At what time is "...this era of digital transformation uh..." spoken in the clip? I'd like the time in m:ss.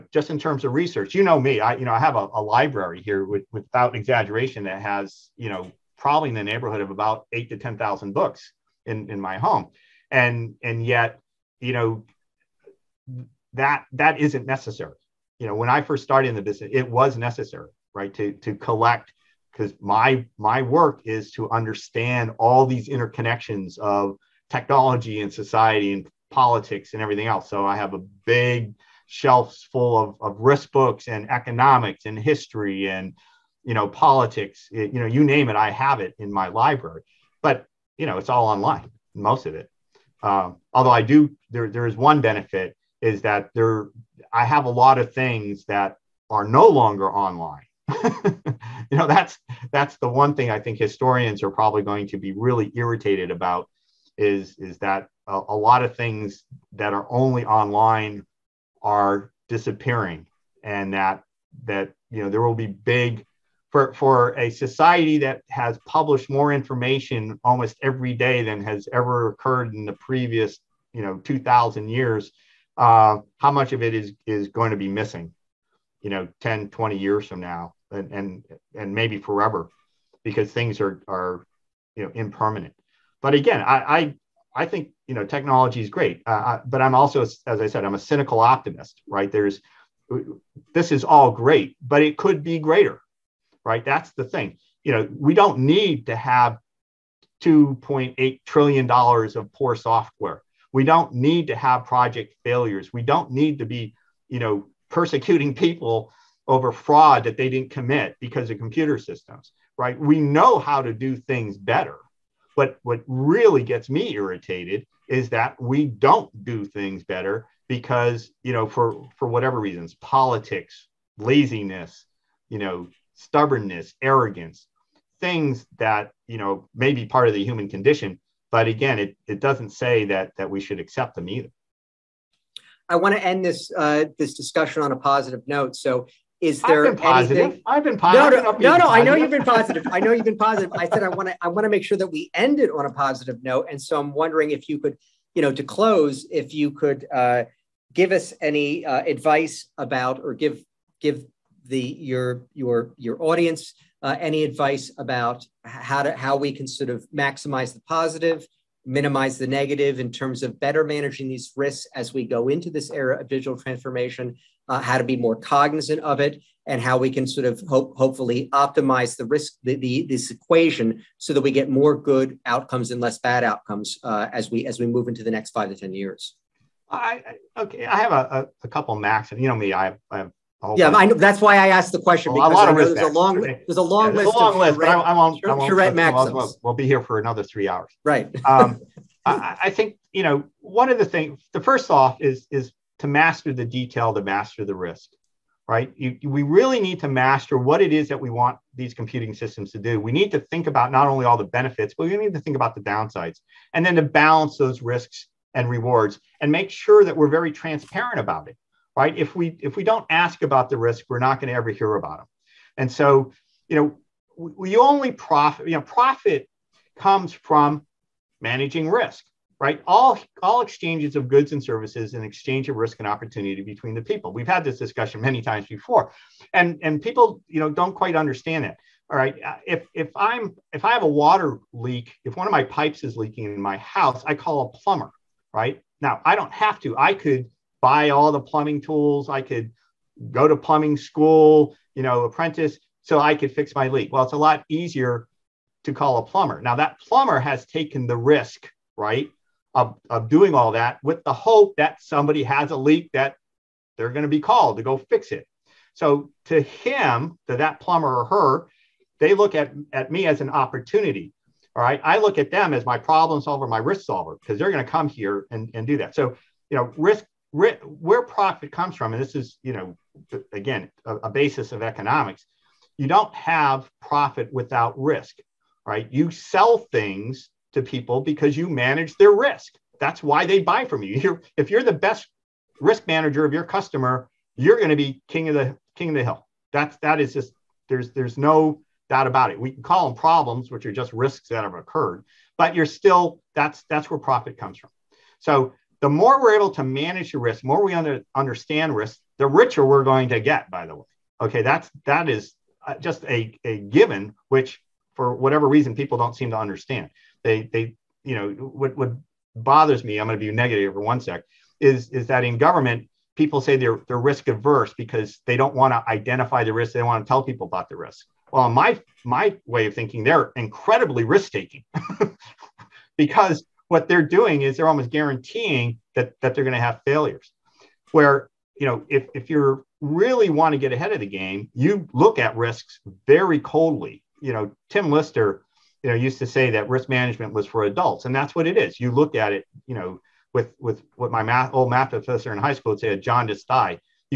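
2:42.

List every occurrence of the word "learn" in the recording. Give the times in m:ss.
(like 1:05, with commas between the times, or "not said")
not said.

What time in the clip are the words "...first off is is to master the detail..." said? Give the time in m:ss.
3:11.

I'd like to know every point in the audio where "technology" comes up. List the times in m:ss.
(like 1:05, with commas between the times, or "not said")
0:24, 1:25.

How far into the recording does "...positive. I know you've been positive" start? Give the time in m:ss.
2:19.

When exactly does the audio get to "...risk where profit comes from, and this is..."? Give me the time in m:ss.
4:27.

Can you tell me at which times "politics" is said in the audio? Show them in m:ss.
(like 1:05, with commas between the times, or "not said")
0:26, 0:33, 1:59.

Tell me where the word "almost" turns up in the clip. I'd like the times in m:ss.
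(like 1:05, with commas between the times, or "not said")
1:07, 5:24.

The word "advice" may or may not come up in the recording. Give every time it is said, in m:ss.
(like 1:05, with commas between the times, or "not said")
2:29, 2:34.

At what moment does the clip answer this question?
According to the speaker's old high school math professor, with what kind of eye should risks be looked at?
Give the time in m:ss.
5:43.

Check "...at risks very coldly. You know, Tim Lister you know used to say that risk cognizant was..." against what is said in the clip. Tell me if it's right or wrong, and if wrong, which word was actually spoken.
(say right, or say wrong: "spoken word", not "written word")
wrong: "management", not "cognizant".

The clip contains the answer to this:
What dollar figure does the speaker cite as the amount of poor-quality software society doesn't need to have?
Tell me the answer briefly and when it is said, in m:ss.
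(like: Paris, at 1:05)
2.8 trillion dollars, at 1:37.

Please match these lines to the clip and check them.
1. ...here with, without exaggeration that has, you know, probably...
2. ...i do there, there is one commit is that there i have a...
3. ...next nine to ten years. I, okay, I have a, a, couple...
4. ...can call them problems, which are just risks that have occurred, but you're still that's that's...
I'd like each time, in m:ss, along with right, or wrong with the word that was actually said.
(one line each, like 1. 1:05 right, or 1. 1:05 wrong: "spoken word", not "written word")
1. 0:03 right
2. 0:40 wrong: "benefit", not "commit"
3. 2:55 wrong: "five", not "nine"
4. 4:49 right.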